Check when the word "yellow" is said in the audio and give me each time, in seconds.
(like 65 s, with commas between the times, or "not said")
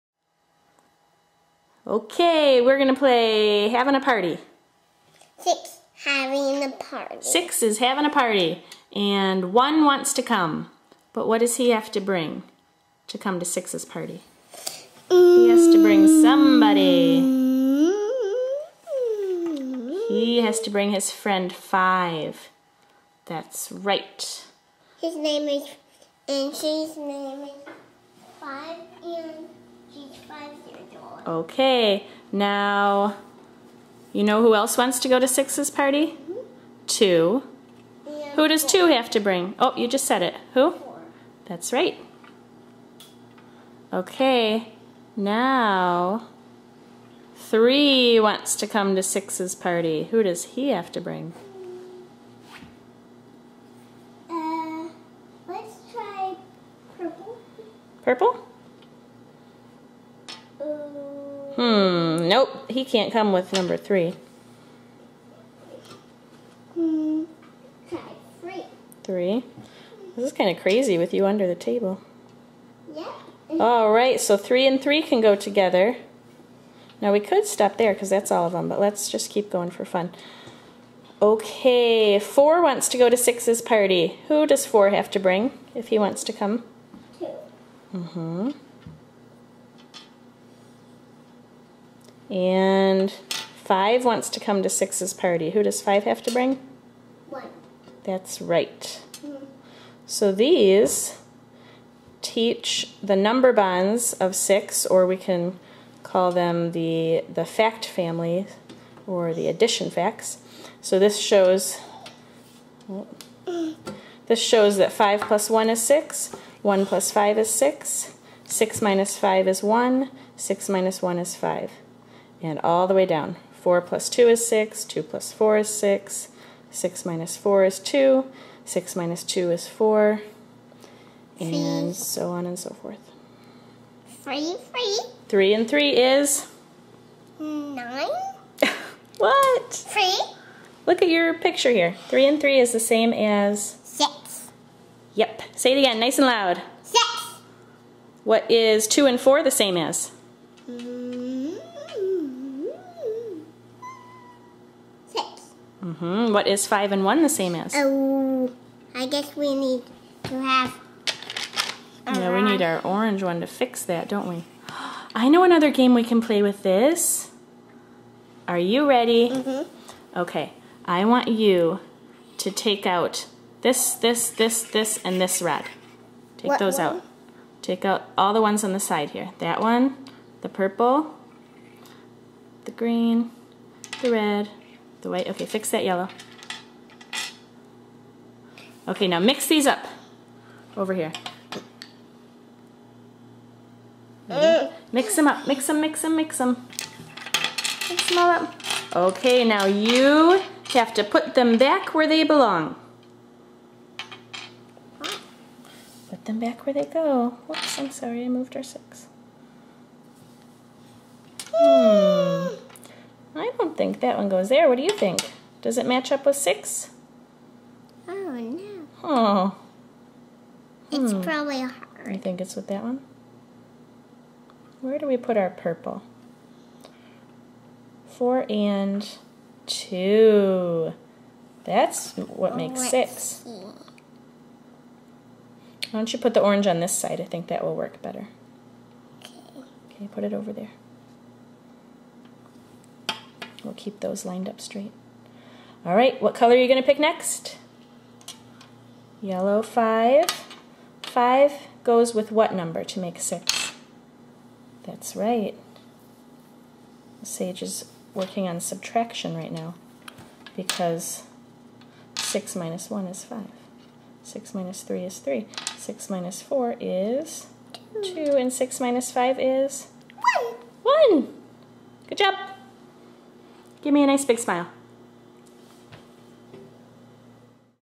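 185 s, 249 s.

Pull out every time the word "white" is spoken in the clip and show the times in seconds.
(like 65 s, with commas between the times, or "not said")
185 s.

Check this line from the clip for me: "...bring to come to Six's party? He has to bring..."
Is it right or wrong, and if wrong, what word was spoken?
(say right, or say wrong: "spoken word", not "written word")
right.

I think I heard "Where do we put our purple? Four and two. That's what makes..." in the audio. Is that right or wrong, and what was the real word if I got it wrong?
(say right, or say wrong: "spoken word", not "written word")
right.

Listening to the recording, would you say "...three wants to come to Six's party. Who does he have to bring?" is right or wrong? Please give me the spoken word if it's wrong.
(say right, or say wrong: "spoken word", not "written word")
right.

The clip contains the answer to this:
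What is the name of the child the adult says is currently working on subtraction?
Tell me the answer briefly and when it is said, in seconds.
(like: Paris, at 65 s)
Sage, at 257 s.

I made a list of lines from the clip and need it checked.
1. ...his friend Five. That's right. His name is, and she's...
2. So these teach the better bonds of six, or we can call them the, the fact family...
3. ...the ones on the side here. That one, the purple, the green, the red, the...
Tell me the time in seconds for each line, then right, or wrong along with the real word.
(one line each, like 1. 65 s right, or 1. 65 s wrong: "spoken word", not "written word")
1. 20 s right
2. 100 s wrong: "number", not "better"
3. 178 s right.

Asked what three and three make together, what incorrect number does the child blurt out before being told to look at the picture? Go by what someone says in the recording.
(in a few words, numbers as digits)
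9.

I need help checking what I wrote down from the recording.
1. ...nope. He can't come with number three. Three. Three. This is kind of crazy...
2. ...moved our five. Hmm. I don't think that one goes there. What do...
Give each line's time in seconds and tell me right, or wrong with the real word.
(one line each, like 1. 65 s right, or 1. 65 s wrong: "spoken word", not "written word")
1. 62 s right
2. 208 s wrong: "six", not "five".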